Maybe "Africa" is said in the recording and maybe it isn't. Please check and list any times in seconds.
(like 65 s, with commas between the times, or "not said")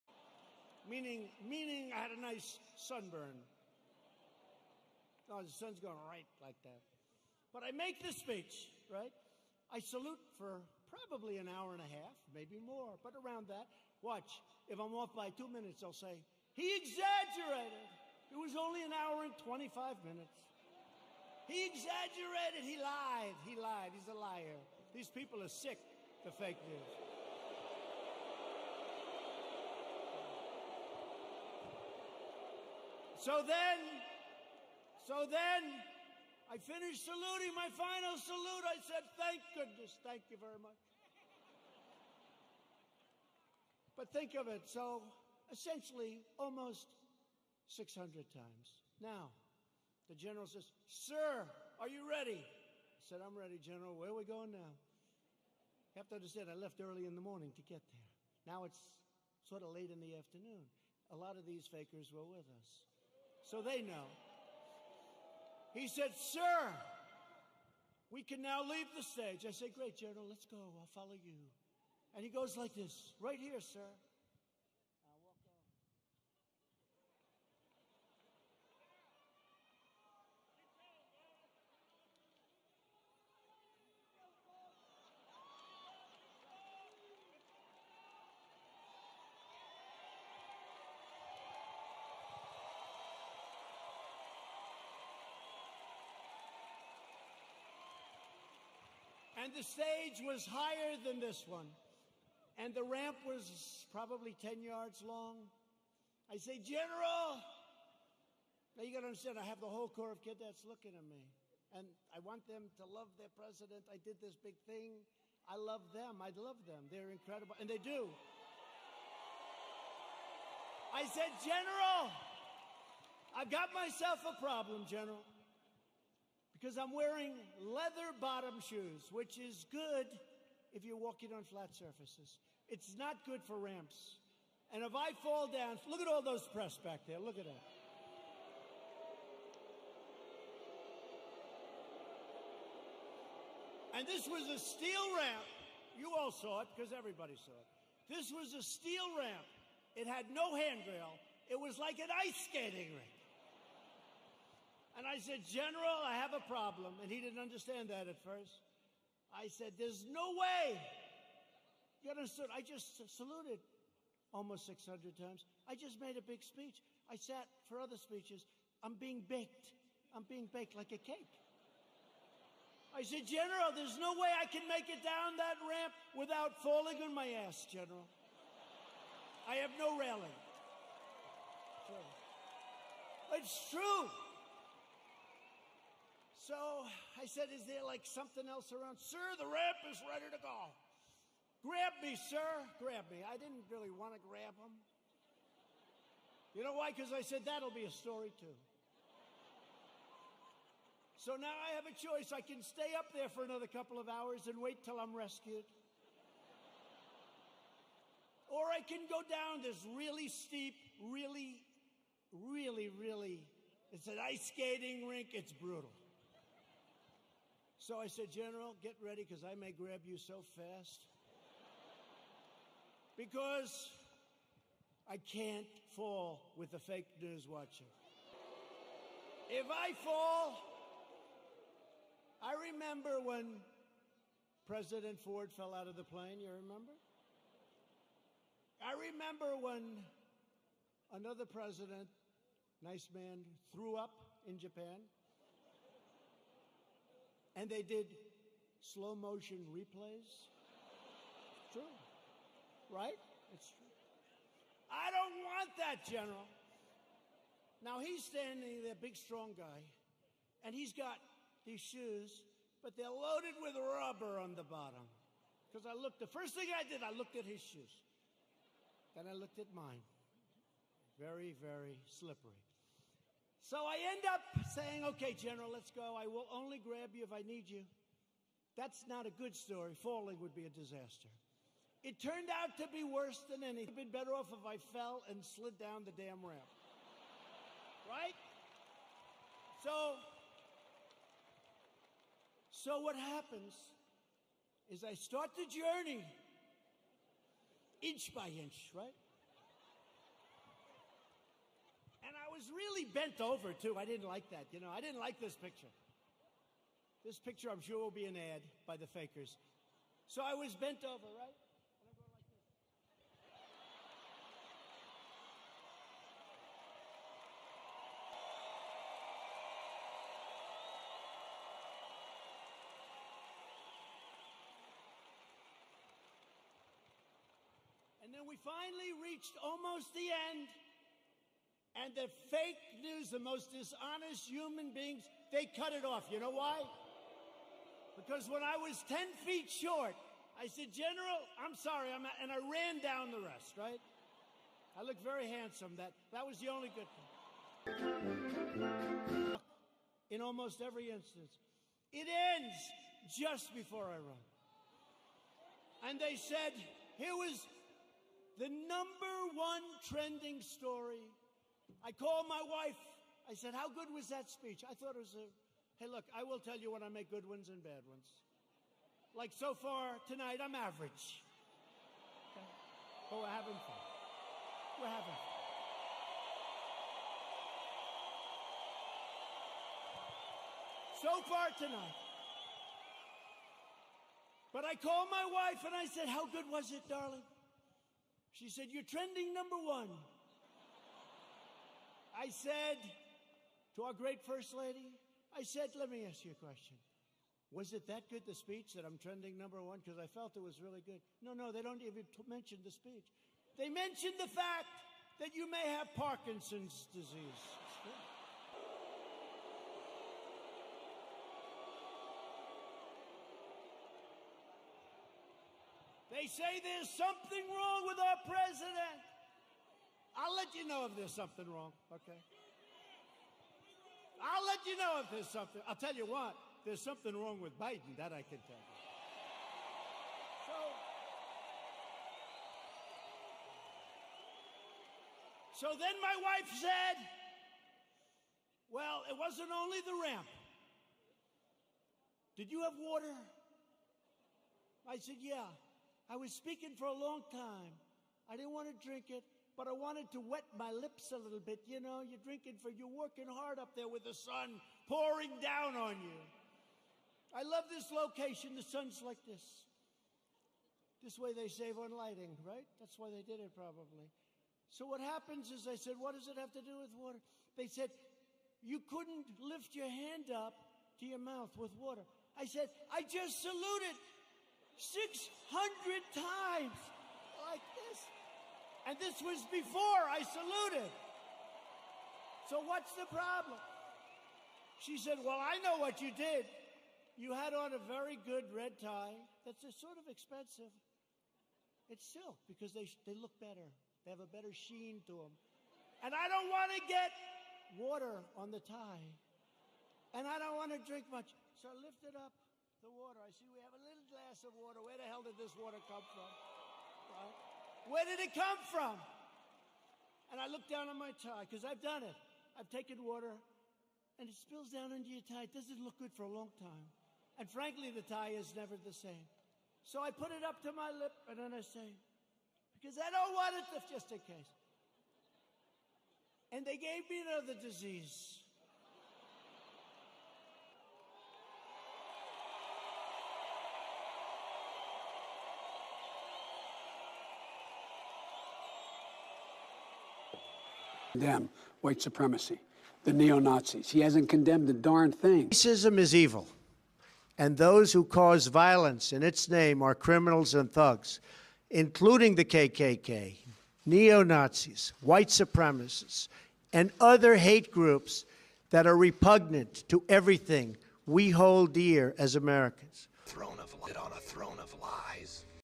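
not said.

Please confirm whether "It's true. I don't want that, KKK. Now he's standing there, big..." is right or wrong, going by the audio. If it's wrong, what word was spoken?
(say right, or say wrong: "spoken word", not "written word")
wrong: "General", not "KKK".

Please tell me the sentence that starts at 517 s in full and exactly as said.
And frankly, the tie is never the same.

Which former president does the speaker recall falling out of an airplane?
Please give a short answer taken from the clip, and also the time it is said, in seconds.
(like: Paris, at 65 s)
President Ford, at 234 s.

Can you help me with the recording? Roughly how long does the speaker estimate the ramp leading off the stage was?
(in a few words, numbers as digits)
10 yards.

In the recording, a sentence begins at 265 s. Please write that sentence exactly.
Because I looked, the first thing I did, I looked at his shoes.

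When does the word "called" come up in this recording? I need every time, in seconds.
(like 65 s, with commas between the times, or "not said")
362 s, 384 s.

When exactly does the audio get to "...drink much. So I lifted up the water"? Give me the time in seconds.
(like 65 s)
501 s.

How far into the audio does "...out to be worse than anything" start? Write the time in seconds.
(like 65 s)
282 s.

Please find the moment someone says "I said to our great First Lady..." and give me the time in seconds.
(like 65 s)
392 s.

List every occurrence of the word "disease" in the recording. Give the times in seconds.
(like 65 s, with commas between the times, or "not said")
407 s, 527 s.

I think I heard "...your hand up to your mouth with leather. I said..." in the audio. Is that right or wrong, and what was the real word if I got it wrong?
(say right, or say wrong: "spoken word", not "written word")
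wrong: "water", not "leather".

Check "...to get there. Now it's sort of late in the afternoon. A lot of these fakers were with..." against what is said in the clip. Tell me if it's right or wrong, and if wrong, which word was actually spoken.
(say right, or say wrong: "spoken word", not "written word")
right.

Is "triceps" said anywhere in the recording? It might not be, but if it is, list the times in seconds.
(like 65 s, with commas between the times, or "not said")
not said.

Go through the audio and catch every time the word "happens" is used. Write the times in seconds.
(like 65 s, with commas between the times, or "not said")
293 s, 465 s.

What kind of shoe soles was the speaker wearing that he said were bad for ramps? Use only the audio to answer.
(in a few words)
leather bottom.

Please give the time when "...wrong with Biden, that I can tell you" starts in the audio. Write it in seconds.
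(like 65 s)
427 s.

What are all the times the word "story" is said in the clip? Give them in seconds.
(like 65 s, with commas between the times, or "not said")
197 s, 279 s, 360 s.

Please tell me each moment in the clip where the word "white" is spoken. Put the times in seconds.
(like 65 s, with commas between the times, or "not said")
542 s, 555 s.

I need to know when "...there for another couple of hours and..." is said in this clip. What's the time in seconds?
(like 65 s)
203 s.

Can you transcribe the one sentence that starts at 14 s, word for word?
Watch, if I'm off by two minutes, they'll say, he exaggerated.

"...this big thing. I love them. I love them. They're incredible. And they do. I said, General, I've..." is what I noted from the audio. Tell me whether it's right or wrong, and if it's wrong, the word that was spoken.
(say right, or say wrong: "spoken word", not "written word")
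right.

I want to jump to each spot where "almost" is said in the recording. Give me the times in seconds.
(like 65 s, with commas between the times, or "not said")
46 s, 164 s, 329 s, 350 s.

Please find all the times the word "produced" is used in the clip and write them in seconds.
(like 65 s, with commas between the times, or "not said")
not said.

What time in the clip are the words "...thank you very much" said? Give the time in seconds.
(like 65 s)
40 s.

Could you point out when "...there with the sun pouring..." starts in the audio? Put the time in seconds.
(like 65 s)
453 s.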